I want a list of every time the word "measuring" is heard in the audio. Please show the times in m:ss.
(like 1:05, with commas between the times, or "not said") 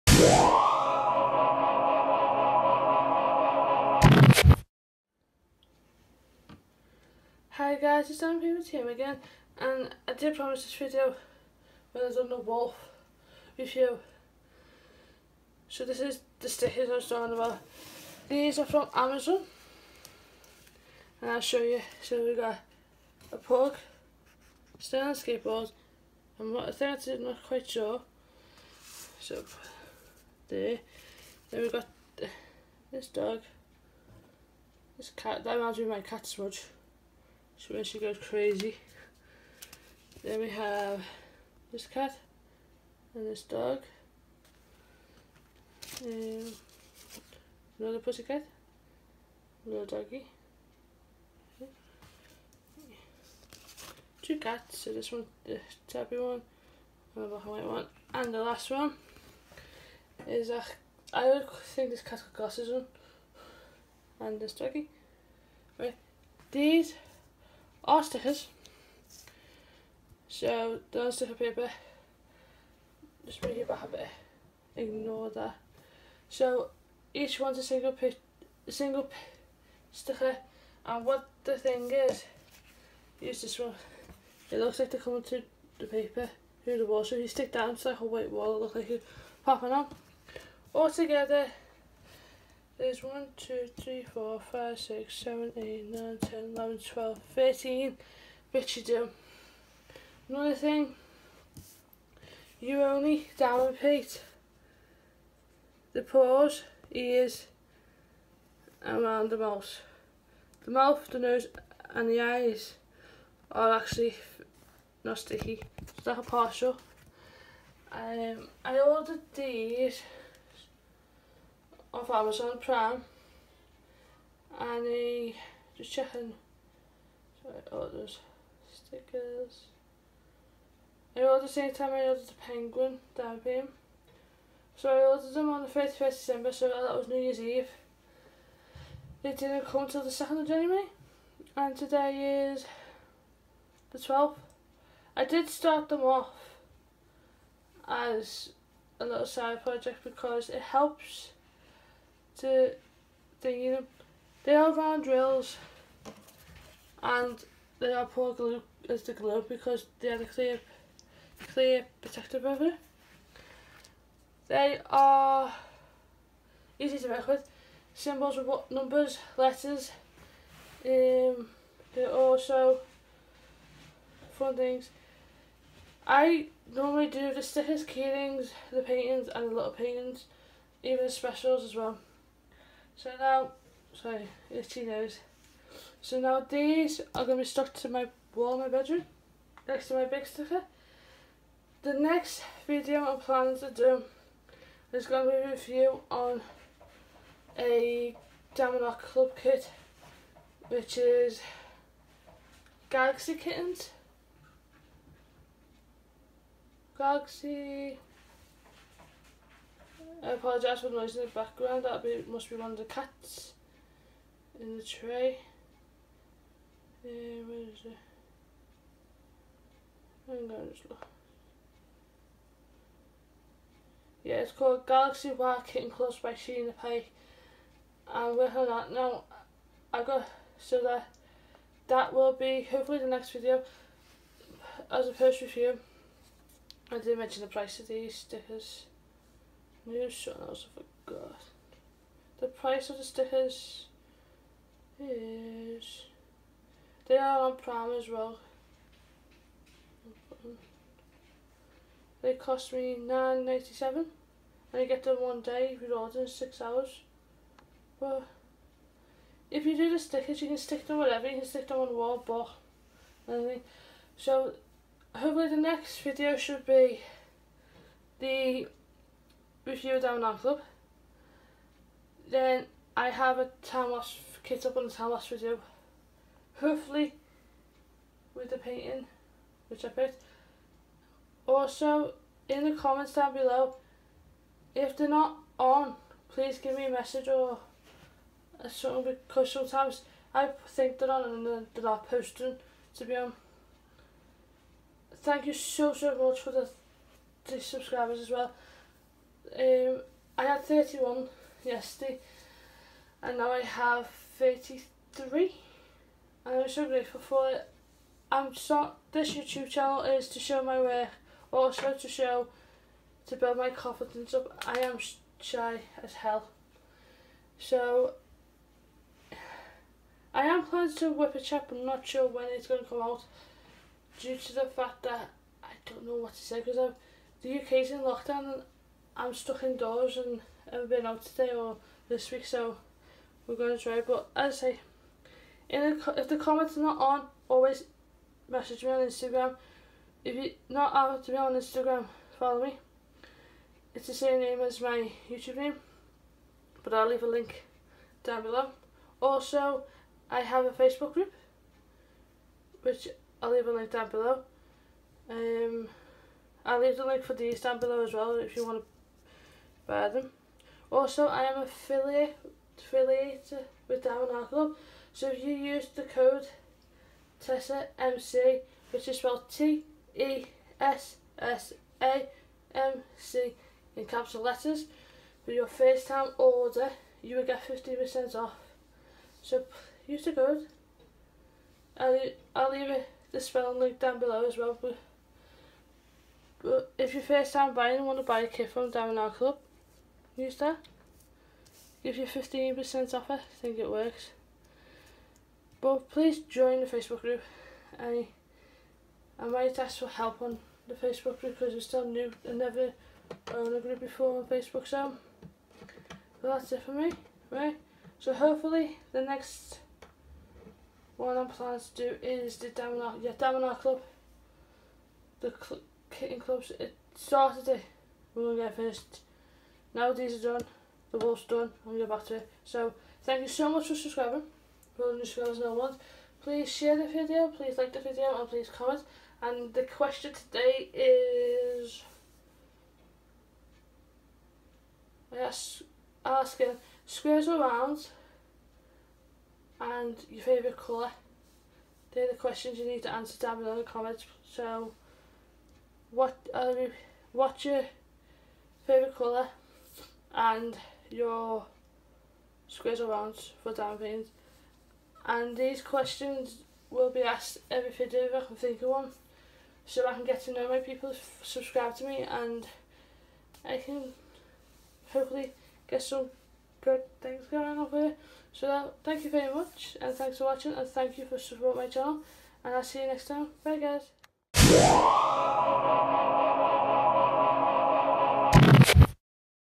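not said.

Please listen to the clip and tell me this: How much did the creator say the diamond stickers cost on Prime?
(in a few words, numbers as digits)
9.97.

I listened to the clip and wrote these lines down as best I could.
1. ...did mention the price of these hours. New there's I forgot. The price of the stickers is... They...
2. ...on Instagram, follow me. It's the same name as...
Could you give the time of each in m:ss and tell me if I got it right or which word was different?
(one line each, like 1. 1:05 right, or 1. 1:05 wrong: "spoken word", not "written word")
1. 3:56 wrong: "stickers", not "hours"
2. 5:41 right.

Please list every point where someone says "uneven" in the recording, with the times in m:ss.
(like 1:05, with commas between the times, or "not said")
not said.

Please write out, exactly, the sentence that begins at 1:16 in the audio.
So each one's a single pic, a single sticker, and what the thing is, use this one.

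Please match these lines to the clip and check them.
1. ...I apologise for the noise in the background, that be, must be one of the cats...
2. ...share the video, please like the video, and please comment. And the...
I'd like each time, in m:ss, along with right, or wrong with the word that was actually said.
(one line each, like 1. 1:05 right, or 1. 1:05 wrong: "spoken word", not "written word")
1. 3:30 right
2. 7:06 right.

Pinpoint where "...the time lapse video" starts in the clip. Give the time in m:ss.
4:34.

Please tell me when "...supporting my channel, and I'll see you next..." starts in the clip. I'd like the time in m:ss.
7:51.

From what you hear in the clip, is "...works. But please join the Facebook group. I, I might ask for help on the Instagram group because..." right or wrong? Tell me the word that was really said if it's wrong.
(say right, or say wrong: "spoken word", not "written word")
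wrong: "Facebook", not "Instagram".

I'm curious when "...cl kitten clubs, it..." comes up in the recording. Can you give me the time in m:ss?
6:55.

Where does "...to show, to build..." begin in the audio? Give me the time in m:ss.
5:11.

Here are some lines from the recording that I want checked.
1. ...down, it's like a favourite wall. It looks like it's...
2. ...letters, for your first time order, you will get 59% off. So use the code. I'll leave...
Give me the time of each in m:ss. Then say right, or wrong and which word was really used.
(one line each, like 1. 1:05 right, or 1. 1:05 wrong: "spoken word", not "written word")
1. 1:27 wrong: "white", not "favourite"
2. 6:14 wrong: "50", not "59".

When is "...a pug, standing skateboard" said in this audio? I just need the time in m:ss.
0:23.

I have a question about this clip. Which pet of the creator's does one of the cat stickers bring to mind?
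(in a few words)
Smudge.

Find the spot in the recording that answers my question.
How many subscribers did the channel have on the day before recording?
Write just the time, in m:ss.
5:00.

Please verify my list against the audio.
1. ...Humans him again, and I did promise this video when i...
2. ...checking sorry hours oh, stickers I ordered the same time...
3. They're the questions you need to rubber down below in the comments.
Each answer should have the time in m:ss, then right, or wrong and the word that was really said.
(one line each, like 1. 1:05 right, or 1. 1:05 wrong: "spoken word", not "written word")
1. 0:08 right
2. 2:05 wrong: "orders", not "hours"
3. 7:22 wrong: "answer", not "rubber".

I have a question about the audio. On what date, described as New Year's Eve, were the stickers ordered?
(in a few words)
31st December.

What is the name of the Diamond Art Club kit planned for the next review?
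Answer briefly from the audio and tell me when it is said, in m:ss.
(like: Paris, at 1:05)
Galaxy Kittens, at 3:22.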